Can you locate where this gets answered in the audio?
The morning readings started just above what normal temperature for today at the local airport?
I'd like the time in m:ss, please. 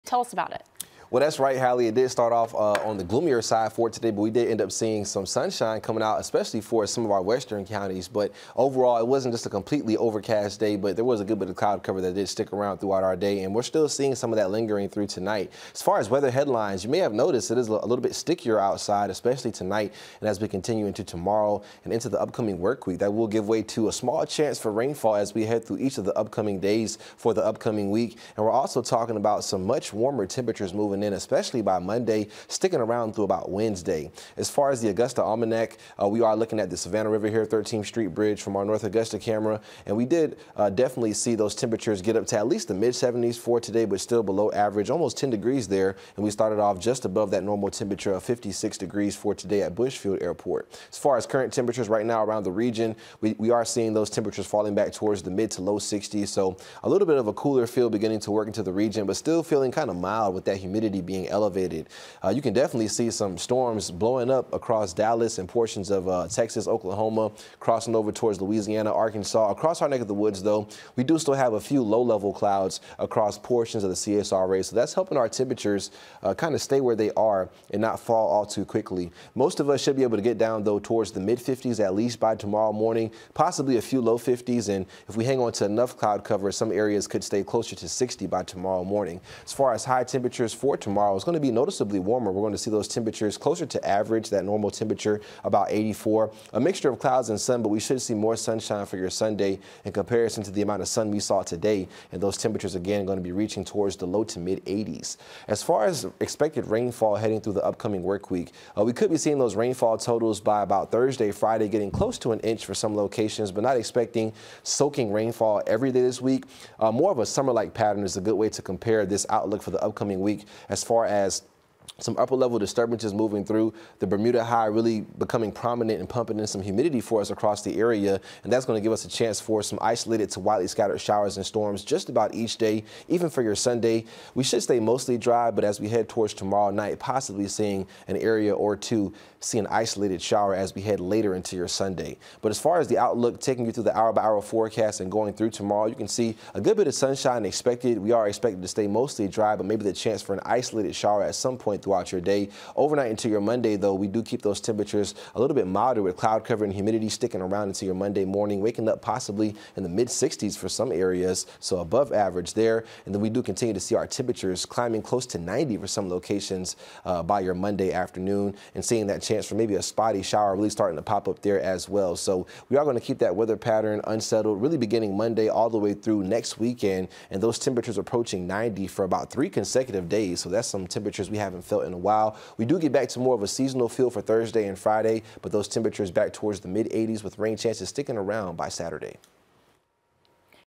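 0:48.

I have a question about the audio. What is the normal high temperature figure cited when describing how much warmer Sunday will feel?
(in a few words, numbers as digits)
84.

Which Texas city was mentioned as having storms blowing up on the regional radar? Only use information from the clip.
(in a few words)
Dallas.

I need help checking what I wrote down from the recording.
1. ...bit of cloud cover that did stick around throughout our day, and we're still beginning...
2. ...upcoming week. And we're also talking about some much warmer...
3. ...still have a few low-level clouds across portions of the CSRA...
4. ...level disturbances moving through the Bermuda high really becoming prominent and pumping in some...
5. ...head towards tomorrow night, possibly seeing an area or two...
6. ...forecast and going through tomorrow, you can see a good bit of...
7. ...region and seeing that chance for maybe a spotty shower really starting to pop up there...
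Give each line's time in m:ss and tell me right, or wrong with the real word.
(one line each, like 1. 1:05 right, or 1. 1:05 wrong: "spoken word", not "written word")
1. 0:11 wrong: "seeing", not "beginning"
2. 0:27 right
3. 1:11 right
4. 2:02 right
5. 2:15 right
6. 2:24 right
7. 2:47 wrong: "afternoon", not "region".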